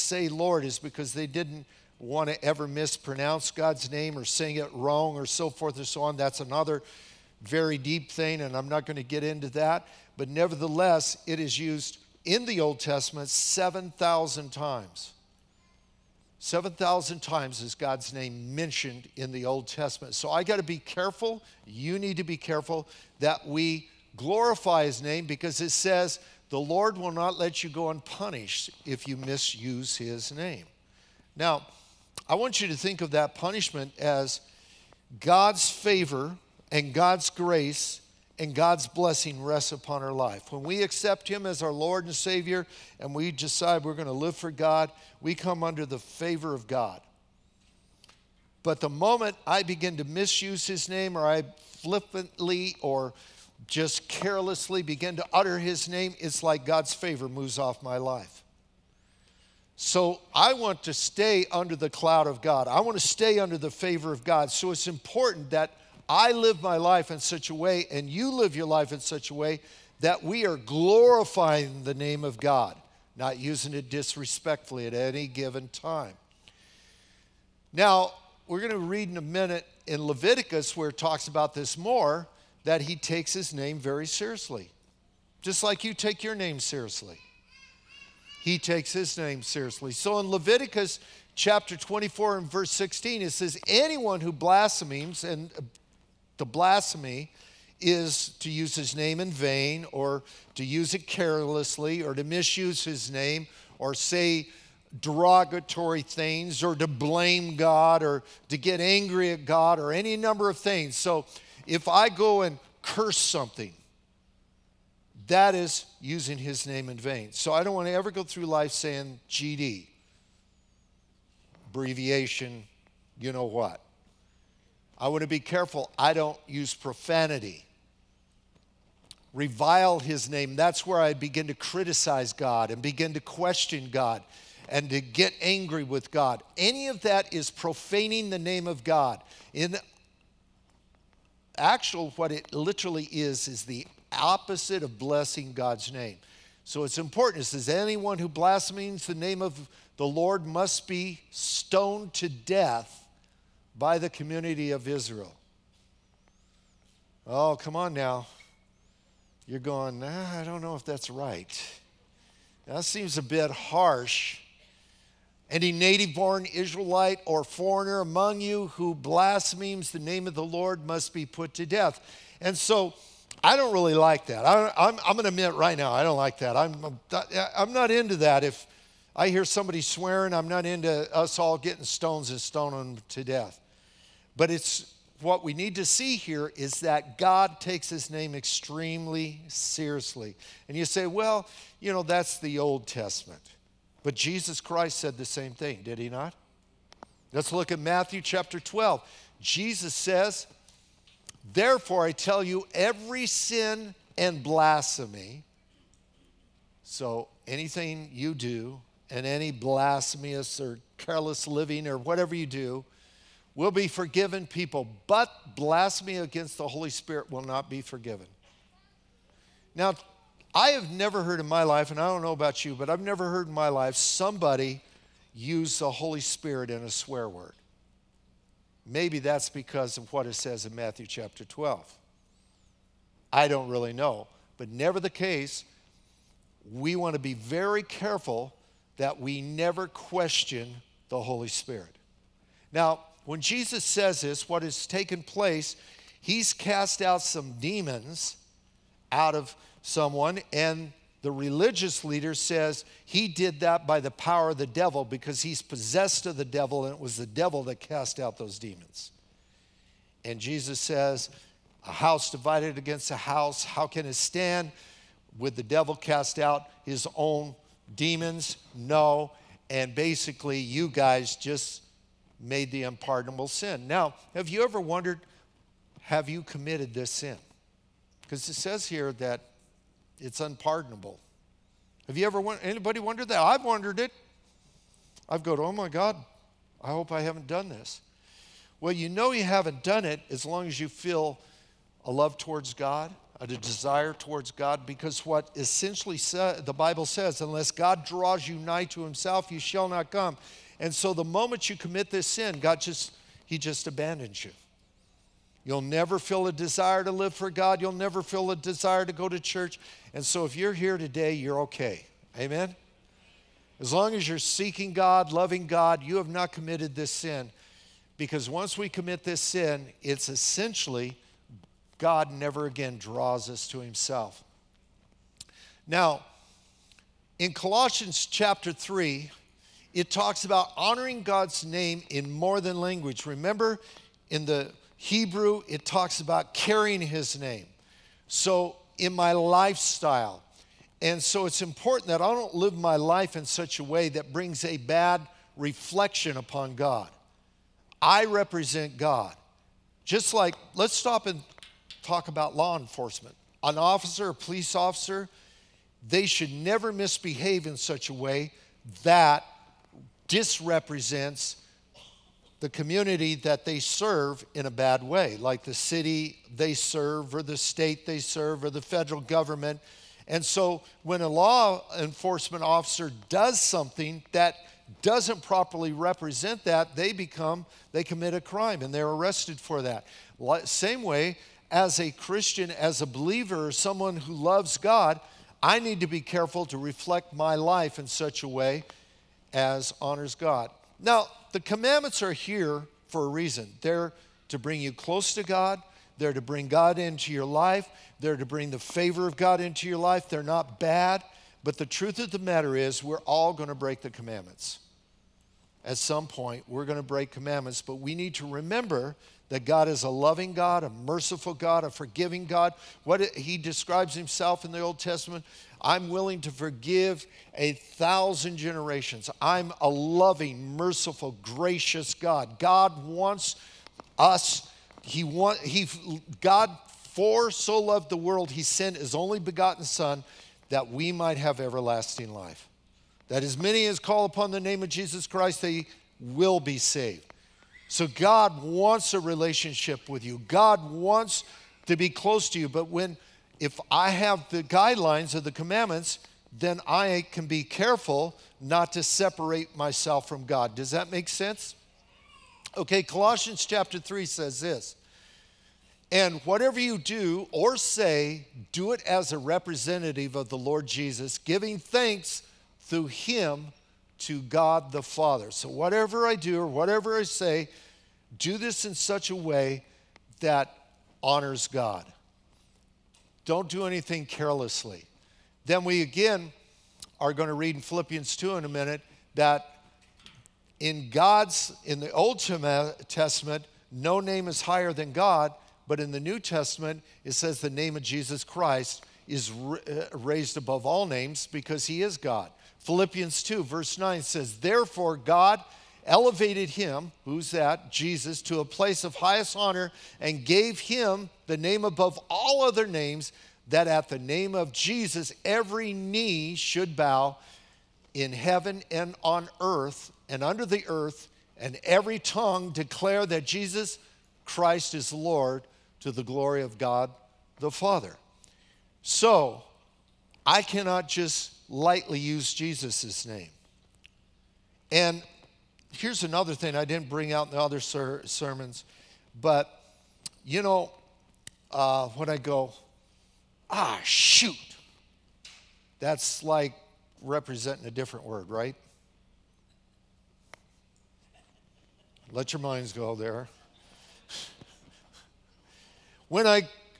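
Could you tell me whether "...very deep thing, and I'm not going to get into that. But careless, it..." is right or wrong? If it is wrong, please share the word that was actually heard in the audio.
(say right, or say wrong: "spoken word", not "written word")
wrong: "nevertheless", not "careless".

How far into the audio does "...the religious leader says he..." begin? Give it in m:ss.
4:11.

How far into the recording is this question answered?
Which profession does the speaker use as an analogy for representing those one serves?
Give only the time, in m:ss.
5:54.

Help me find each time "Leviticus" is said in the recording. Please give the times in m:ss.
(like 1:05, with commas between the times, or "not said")
1:20, 1:30.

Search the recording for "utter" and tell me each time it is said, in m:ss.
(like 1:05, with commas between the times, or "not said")
0:55.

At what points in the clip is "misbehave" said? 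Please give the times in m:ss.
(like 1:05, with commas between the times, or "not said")
5:56.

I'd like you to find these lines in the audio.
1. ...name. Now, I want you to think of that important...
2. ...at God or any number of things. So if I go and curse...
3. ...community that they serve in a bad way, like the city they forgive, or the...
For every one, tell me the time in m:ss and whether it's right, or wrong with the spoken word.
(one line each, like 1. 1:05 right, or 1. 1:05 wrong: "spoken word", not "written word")
1. 0:30 wrong: "punishment", not "important"
2. 1:49 right
3. 6:02 wrong: "serve", not "forgive".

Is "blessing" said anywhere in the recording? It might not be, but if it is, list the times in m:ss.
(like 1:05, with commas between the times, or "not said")
0:38, 2:24.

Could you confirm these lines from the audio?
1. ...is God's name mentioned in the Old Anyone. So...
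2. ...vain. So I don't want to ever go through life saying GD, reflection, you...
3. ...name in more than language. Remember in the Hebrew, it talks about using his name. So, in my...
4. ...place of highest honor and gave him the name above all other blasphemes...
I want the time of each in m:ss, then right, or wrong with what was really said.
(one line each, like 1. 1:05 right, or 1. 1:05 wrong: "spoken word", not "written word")
1. 0:17 wrong: "Testament", not "Anyone"
2. 1:56 wrong: "abbreviation", not "reflection"
3. 5:31 wrong: "carrying", not "using"
4. 8:18 wrong: "names", not "blasphemes".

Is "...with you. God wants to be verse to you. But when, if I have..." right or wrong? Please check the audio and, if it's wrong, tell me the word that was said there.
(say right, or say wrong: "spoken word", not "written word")
wrong: "close", not "verse".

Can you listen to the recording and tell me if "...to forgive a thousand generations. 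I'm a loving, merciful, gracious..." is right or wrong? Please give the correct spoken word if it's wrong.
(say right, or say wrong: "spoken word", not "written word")
right.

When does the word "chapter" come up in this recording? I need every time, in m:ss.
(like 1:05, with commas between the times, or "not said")
1:31, 3:18, 3:51, 5:28, 7:33.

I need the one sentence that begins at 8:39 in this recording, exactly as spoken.
So, I cannot just lightly use Jesus' name.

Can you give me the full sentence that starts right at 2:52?
And so, I don't really like that.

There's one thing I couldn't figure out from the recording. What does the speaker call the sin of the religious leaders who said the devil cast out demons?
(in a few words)
Unpardonable sin.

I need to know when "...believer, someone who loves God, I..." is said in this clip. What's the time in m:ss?
6:23.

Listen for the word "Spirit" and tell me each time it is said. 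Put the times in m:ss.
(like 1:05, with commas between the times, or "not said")
3:36, 3:46, 4:01.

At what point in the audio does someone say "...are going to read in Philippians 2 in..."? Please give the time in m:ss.
7:57.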